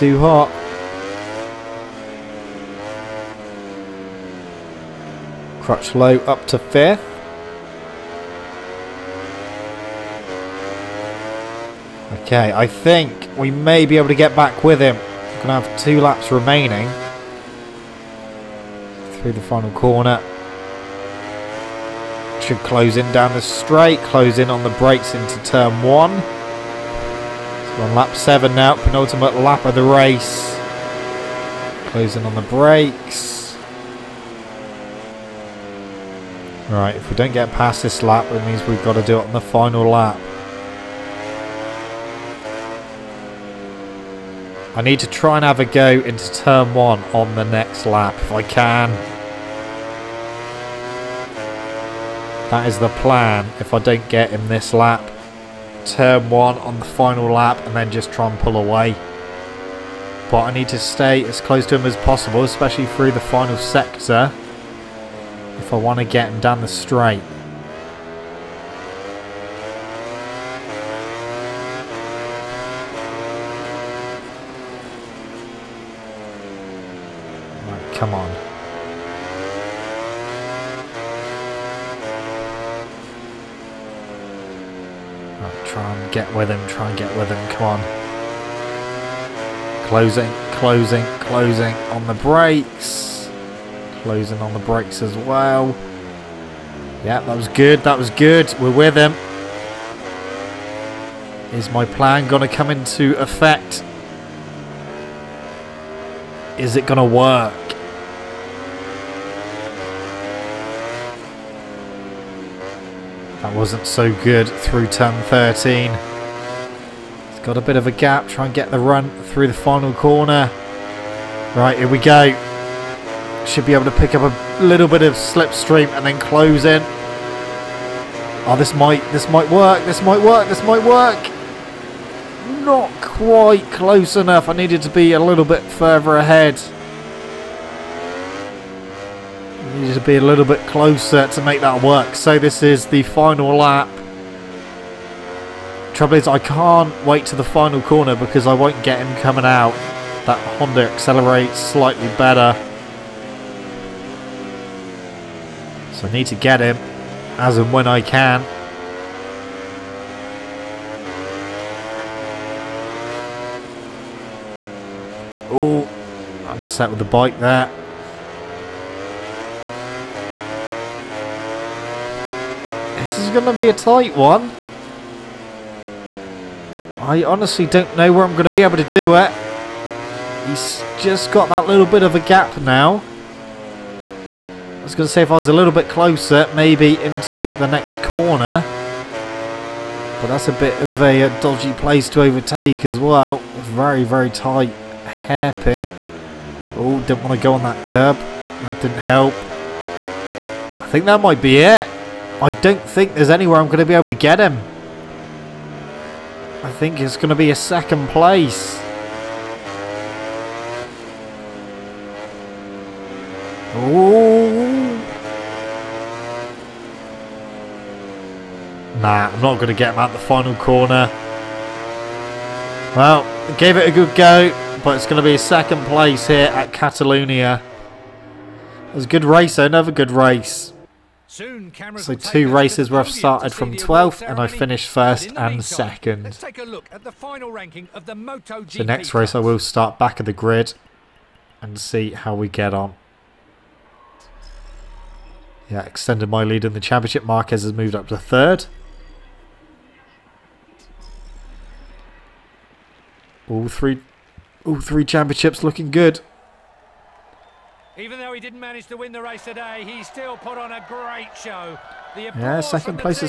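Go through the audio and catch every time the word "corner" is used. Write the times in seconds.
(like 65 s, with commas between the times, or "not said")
19 s, 119 s, 147 s, 188 s, 220 s.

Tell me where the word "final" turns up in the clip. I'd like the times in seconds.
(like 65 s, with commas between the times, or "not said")
19 s, 39 s, 56 s, 63 s, 119 s, 143 s, 147 s, 220 s.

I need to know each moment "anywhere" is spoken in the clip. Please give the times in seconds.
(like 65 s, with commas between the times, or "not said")
203 s.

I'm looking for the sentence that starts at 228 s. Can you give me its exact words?
It was a good race, though, another good race.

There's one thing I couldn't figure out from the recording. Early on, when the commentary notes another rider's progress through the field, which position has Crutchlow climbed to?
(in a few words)
5th.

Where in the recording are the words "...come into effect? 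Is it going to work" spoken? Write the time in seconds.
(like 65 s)
102 s.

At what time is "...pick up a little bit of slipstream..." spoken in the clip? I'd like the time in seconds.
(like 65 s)
123 s.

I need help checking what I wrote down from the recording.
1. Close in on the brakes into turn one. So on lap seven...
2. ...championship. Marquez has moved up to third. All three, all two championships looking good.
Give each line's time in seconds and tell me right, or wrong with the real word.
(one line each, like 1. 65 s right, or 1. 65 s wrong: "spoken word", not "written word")
1. 23 s right
2. 246 s wrong: "three", not "two".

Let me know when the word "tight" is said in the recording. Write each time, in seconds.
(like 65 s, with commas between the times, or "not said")
173 s, 194 s.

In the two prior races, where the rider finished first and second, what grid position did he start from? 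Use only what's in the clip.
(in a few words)
12th.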